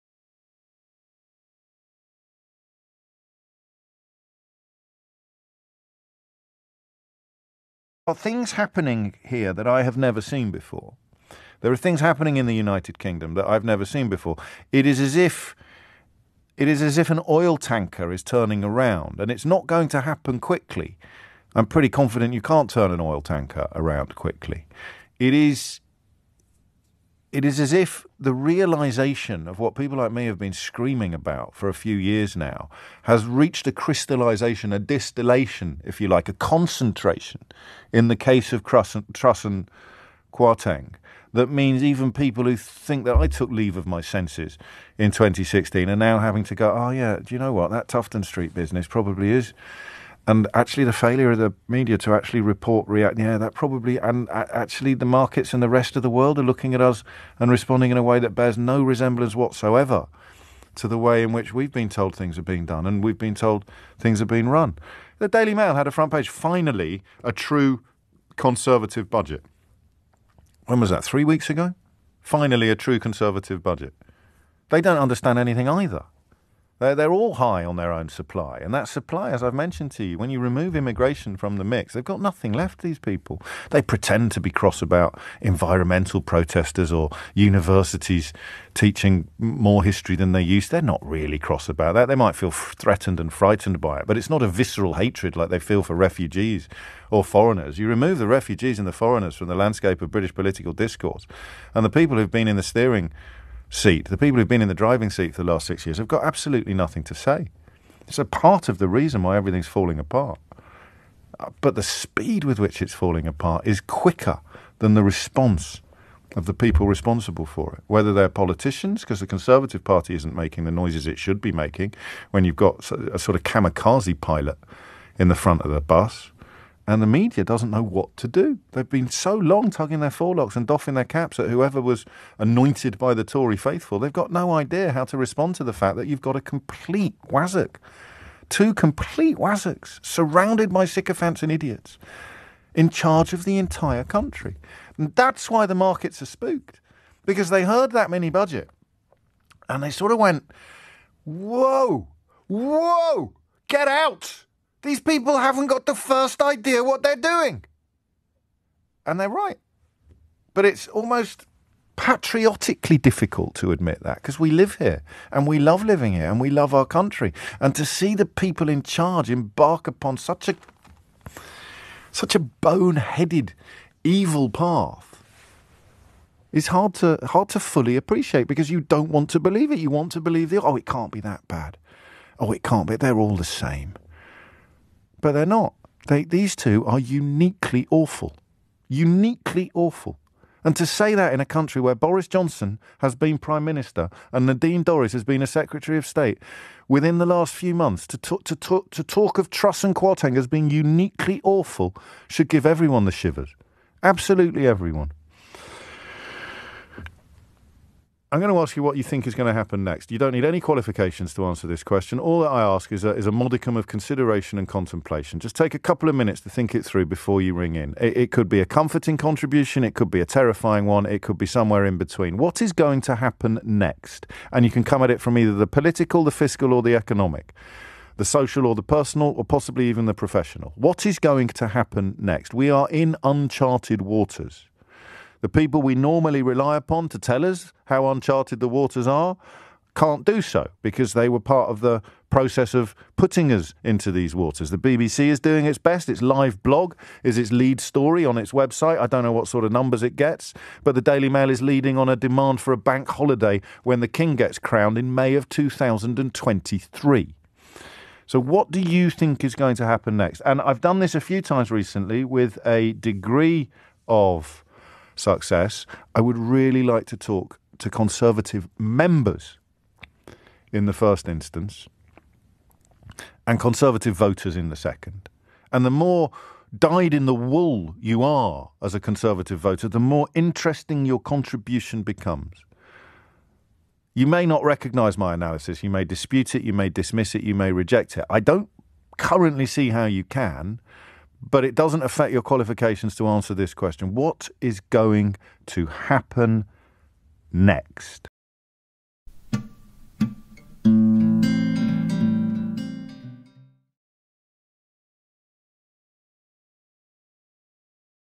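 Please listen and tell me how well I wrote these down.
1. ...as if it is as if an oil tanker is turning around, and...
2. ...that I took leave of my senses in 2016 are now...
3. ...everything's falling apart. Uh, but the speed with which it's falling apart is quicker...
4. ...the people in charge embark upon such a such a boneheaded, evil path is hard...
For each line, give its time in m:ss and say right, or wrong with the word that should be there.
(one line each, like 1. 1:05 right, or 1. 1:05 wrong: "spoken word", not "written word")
1. 0:14 right
2. 0:43 right
3. 1:49 right
4. 2:48 right.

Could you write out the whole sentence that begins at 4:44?
You may not recognise my analysis, you may dispute it, you may dismiss it, you may reject it.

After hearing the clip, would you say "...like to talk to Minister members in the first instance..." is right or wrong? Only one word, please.
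wrong.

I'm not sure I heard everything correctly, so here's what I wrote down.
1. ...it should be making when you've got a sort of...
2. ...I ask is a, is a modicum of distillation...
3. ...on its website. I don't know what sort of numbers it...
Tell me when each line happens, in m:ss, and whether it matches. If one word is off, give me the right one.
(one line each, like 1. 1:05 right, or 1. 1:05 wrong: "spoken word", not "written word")
1. 2:01 right
2. 3:32 wrong: "consideration", not "distillation"
3. 4:08 right.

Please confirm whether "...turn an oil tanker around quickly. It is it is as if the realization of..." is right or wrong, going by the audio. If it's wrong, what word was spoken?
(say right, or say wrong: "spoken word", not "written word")
right.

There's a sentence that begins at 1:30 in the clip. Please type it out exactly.
They're not really cross about that.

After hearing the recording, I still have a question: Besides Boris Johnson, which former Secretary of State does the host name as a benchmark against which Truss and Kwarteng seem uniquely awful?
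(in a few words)
Nadine Dorries.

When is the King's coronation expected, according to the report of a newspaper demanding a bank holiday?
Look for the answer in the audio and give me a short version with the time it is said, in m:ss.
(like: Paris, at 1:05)
May 2023, at 4:15.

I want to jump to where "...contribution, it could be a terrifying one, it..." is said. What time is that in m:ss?
3:39.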